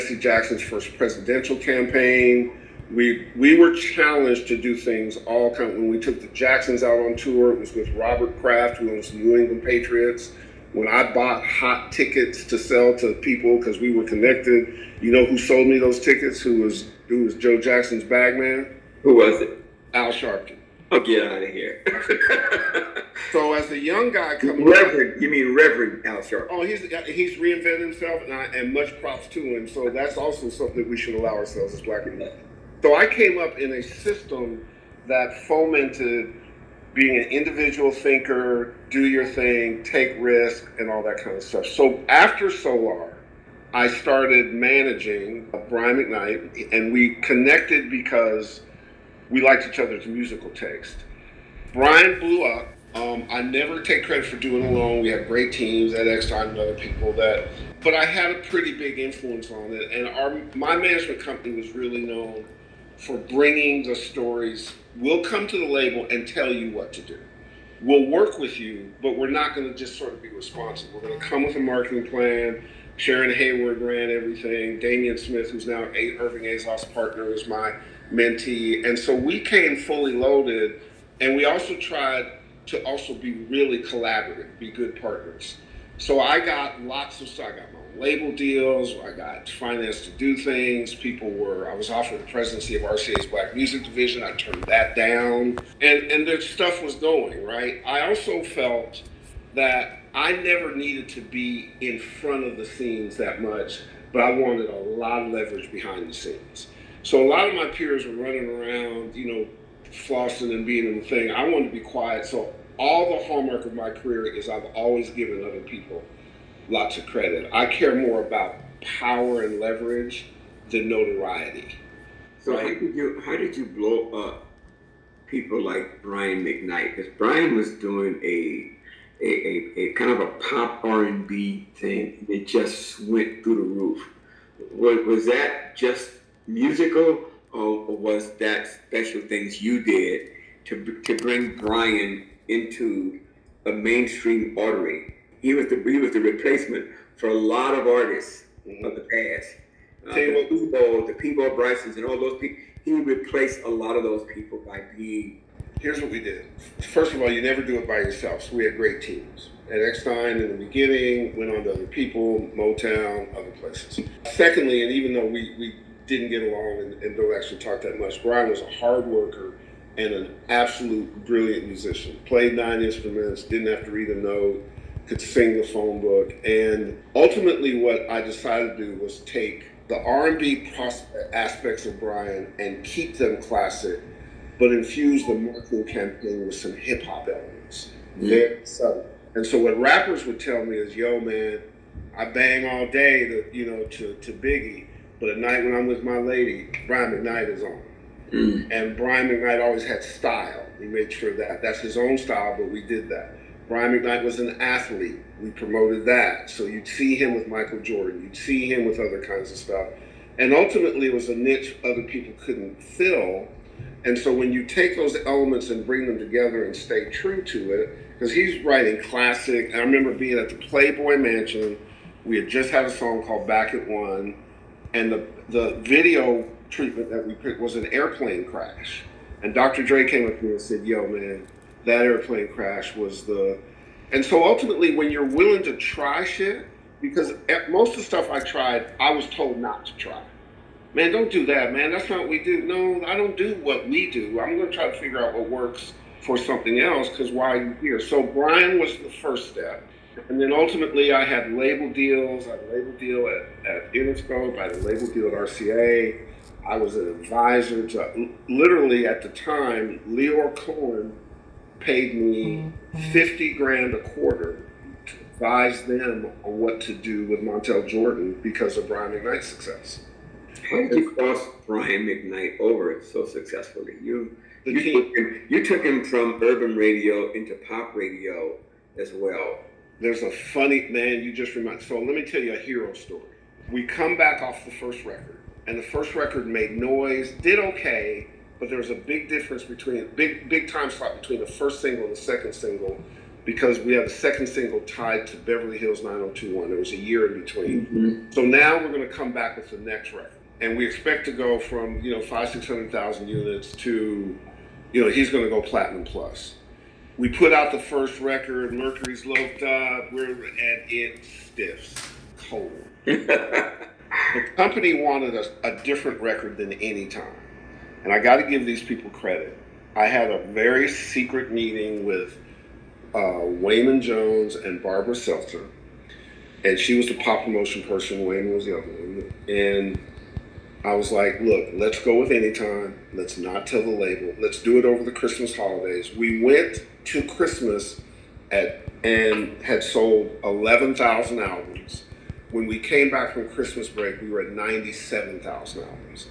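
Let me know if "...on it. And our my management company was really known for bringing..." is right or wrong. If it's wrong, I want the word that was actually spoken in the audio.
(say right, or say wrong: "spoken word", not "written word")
right.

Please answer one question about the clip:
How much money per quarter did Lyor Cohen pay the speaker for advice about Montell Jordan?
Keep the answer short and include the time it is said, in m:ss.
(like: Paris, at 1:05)
50 grand, at 4:23.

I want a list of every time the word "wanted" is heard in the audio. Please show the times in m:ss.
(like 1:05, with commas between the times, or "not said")
1:44, 1:51, 5:15.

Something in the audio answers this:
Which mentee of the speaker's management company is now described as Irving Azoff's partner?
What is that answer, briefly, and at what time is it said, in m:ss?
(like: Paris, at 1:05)
Damian Smith, at 1:14.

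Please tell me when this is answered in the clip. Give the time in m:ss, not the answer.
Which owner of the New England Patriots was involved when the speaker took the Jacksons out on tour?
0:07.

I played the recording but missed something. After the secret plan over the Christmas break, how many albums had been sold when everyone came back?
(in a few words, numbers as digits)
97,000.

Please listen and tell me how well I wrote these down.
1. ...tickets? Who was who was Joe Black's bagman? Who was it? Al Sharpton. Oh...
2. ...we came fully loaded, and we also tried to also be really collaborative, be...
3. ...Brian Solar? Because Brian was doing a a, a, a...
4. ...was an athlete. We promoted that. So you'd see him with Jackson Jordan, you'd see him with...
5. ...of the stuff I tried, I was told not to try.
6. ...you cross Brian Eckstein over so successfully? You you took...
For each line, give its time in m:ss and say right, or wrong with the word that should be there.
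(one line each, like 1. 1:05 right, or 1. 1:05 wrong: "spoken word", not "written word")
1. 0:15 wrong: "Jackson", not "Black"
2. 1:19 right
3. 2:06 wrong: "McKnight", not "Solar"
4. 3:24 wrong: "Michael", not "Jackson"
5. 3:57 right
6. 4:30 wrong: "McKnight", not "Eckstein".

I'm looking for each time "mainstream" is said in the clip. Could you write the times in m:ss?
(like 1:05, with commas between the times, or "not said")
2:23.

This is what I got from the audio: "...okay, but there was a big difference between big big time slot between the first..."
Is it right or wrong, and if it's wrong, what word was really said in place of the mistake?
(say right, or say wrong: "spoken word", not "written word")
right.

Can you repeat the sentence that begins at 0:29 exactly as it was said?
So that's also something we should allow ourselves as black people.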